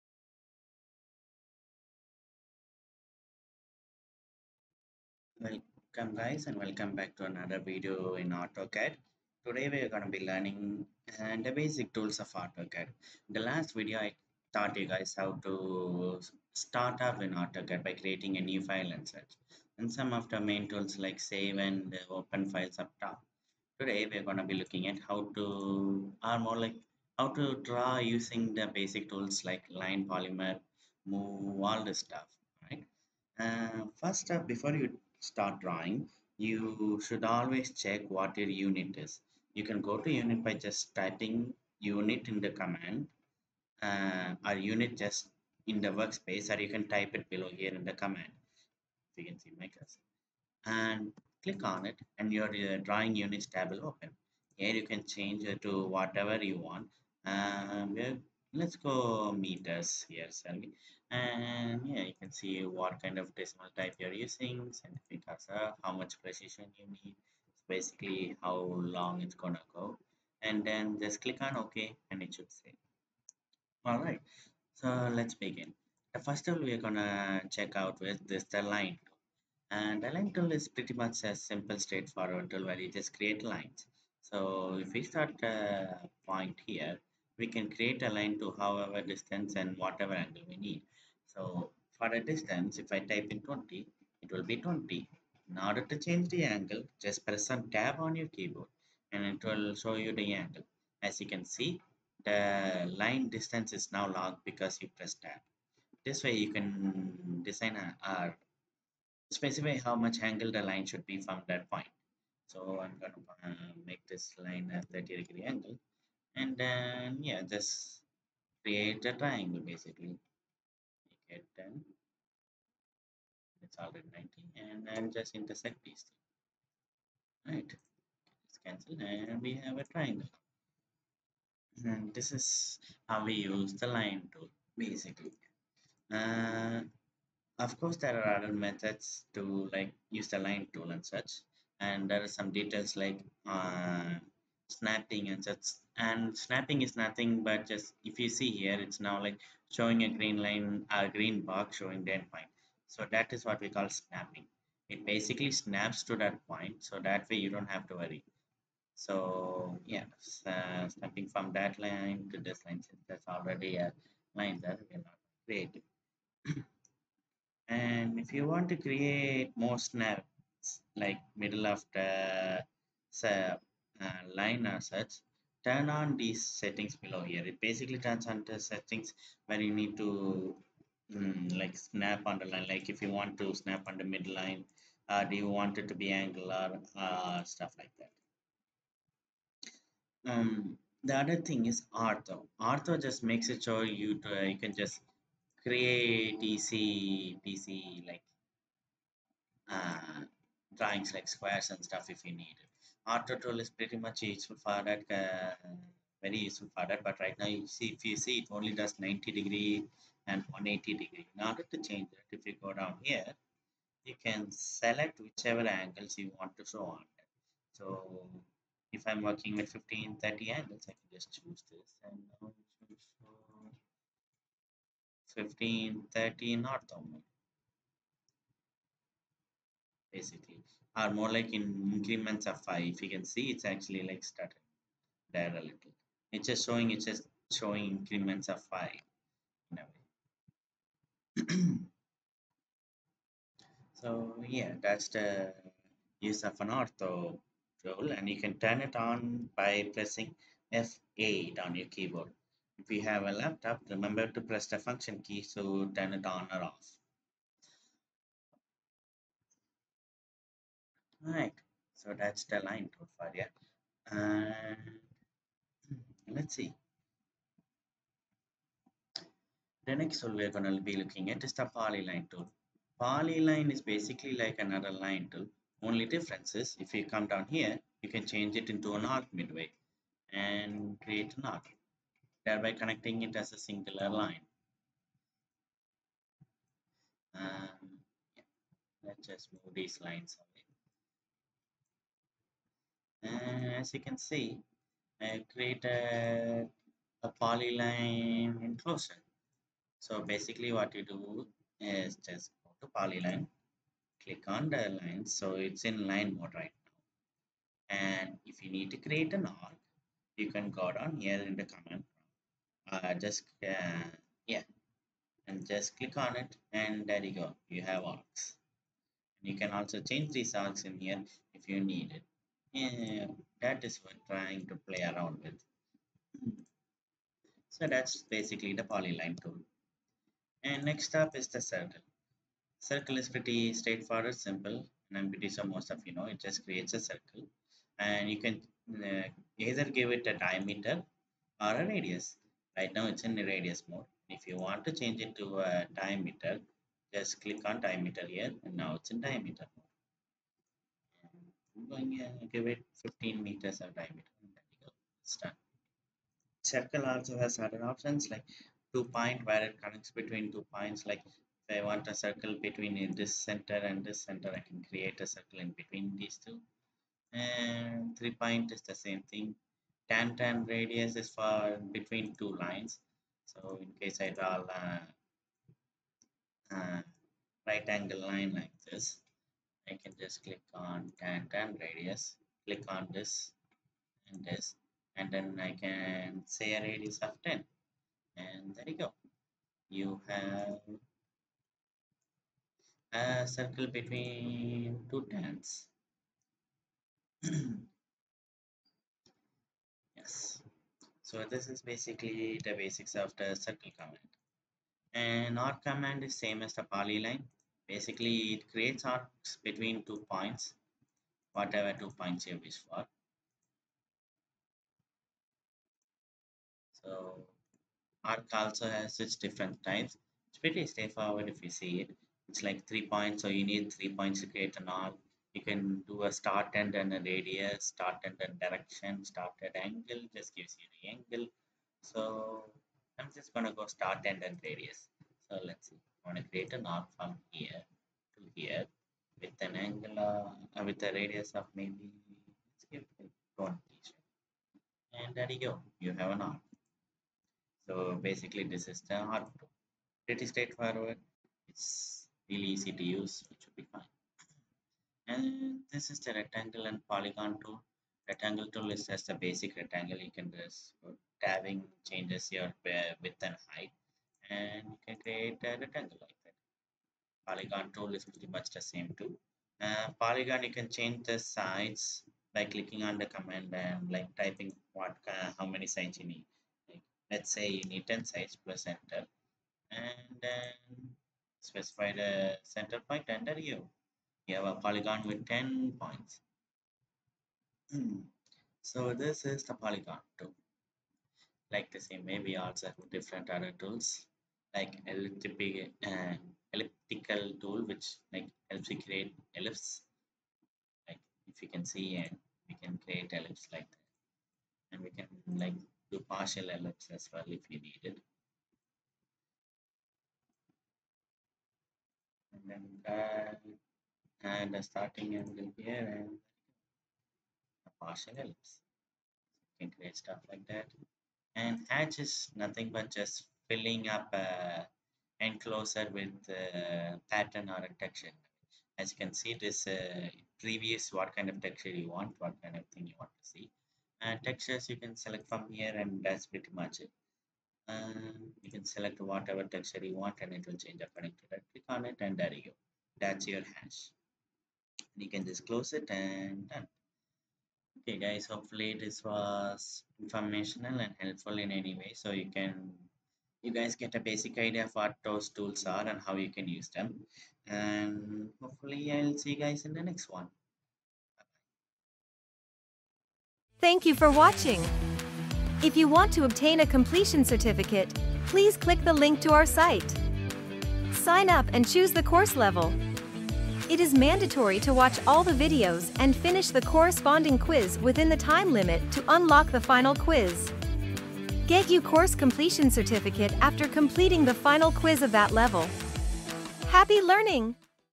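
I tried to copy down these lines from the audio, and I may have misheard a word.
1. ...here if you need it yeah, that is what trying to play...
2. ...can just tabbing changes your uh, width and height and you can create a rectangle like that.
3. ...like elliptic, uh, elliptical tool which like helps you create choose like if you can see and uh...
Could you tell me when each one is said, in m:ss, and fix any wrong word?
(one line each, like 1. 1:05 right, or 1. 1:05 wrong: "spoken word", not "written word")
1. 5:20 right
2. 7:40 right
3. 8:14 wrong: "ellipse", not "choose".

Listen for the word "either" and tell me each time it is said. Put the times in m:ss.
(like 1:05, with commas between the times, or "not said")
5:39.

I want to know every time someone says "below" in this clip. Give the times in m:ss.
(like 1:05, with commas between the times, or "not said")
0:47, 2:56.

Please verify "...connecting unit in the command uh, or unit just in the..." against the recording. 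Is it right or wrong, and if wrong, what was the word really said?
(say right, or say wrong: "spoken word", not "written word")
wrong: "typing", not "connecting".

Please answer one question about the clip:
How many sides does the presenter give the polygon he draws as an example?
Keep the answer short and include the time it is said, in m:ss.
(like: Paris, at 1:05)
10, at 7:58.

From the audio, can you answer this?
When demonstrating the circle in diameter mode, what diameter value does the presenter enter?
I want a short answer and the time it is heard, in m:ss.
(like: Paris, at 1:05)
15 meters, at 5:53.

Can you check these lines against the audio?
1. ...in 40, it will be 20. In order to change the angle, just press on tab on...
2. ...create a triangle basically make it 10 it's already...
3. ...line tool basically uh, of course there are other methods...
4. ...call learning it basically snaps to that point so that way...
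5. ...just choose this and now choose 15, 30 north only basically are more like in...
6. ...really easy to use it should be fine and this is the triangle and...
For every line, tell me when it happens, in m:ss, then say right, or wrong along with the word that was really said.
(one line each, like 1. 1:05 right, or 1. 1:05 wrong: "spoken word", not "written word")
1. 1:33 wrong: "20", not "40"
2. 1:58 right
3. 2:13 right
4. 2:33 wrong: "snapping", not "learning"
5. 3:41 right
6. 7:32 wrong: "rectangle", not "triangle".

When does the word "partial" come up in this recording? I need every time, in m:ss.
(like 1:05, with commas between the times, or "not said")
8:26, 8:38.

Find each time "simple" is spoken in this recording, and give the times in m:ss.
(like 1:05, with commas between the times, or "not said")
1:21, 5:34.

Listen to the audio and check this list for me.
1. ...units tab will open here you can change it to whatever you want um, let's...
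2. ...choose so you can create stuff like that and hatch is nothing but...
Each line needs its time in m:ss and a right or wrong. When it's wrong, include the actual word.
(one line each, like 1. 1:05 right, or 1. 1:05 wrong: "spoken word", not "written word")
1. 0:53 right
2. 8:38 wrong: "ellipse", not "choose".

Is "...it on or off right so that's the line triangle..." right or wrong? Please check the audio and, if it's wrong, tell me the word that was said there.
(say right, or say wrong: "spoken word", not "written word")
wrong: "profile", not "triangle".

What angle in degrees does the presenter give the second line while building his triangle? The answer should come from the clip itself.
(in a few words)
30.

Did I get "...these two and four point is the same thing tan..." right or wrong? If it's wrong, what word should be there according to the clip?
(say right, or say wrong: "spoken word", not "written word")
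wrong: "three", not "four".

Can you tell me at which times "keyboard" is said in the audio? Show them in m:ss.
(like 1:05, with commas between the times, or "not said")
1:38, 4:11.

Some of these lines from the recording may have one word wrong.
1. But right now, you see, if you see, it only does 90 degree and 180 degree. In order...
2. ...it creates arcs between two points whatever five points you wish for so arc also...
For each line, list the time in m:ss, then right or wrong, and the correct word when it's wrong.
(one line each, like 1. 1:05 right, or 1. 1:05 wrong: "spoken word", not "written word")
1. 3:27 right
2. 6:48 wrong: "two", not "five".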